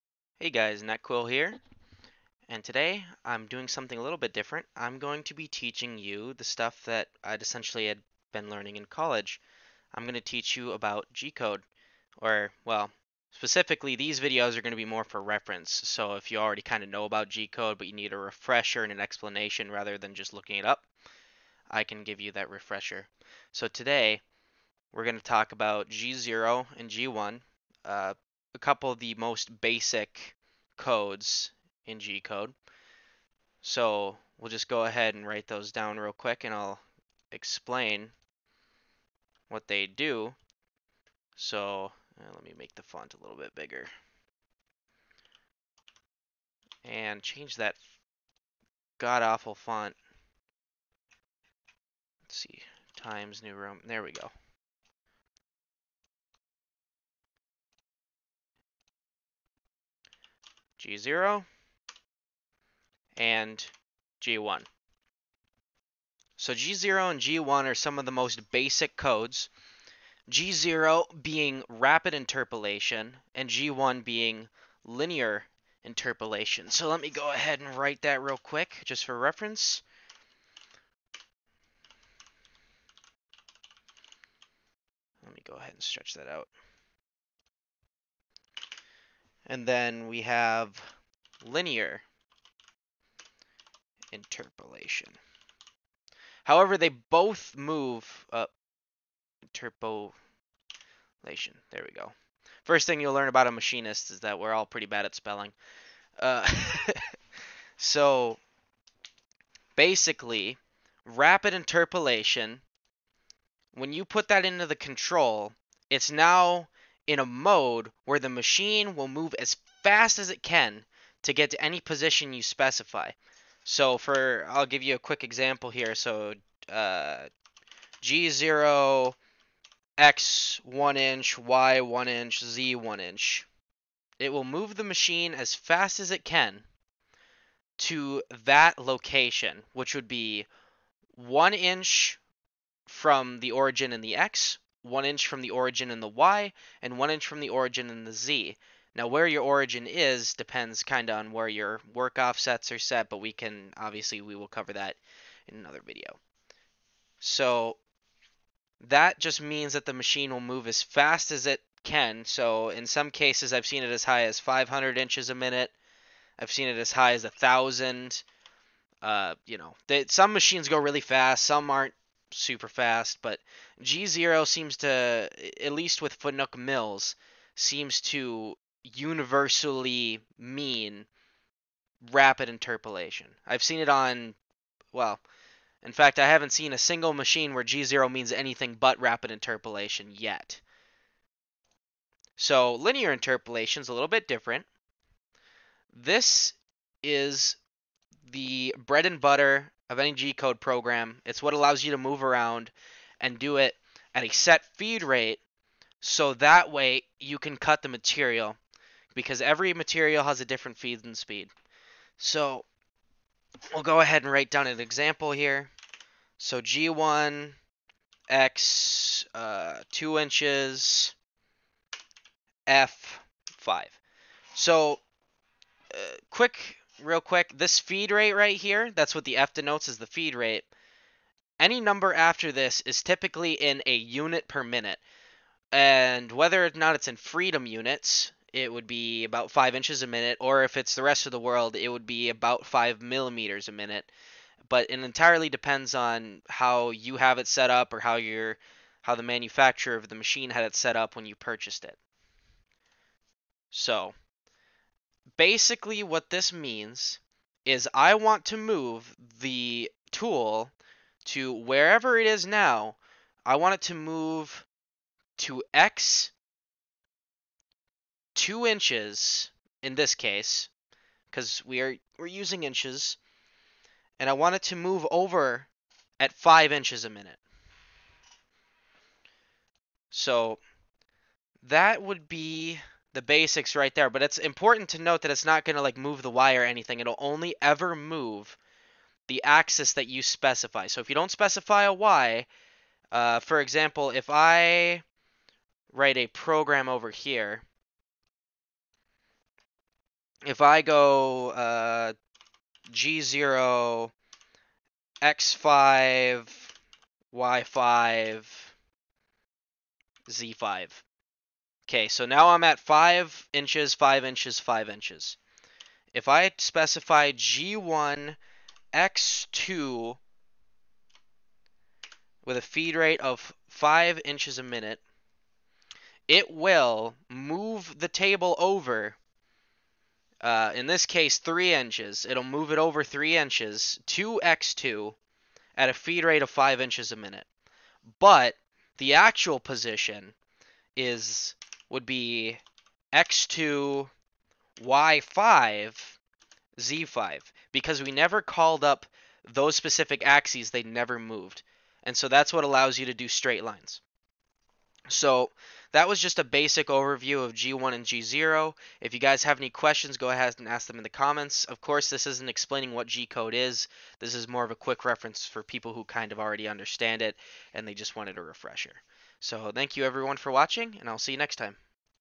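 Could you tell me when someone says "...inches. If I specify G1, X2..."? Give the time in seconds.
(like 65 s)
314 s.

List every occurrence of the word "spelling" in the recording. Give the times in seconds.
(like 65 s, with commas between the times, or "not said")
105 s.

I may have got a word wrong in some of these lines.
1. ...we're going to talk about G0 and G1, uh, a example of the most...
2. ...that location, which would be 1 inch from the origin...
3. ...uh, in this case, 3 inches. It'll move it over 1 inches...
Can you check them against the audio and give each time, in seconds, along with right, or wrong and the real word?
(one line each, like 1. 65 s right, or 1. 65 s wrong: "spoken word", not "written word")
1. 24 s wrong: "couple", not "example"
2. 138 s right
3. 330 s wrong: "3", not "1".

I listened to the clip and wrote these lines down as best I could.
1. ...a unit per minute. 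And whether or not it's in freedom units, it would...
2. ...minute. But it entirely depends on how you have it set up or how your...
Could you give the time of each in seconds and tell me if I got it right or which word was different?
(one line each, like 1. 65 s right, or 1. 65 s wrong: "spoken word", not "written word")
1. 233 s right
2. 243 s right.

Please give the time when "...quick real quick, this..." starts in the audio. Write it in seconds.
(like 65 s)
226 s.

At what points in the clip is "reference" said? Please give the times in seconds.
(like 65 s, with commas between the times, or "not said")
15 s, 79 s, 365 s.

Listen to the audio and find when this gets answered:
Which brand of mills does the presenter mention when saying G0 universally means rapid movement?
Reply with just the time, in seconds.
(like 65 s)
176 s.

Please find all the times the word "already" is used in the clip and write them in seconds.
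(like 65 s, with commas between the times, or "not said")
16 s, 366 s.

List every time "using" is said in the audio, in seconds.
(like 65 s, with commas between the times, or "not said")
272 s.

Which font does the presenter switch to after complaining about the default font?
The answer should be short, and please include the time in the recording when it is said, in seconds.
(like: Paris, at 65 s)
Times New Roman, at 52 s.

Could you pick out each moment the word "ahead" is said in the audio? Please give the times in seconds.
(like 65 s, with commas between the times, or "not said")
34 s, 77 s, 85 s, 213 s, 360 s.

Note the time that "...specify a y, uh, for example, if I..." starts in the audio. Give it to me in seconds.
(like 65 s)
291 s.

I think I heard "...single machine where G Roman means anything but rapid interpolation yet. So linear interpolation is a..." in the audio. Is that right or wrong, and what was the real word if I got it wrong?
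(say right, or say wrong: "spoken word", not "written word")
wrong: "Zero", not "Roman".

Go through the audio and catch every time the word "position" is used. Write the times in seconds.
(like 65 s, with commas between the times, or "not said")
121 s, 339 s.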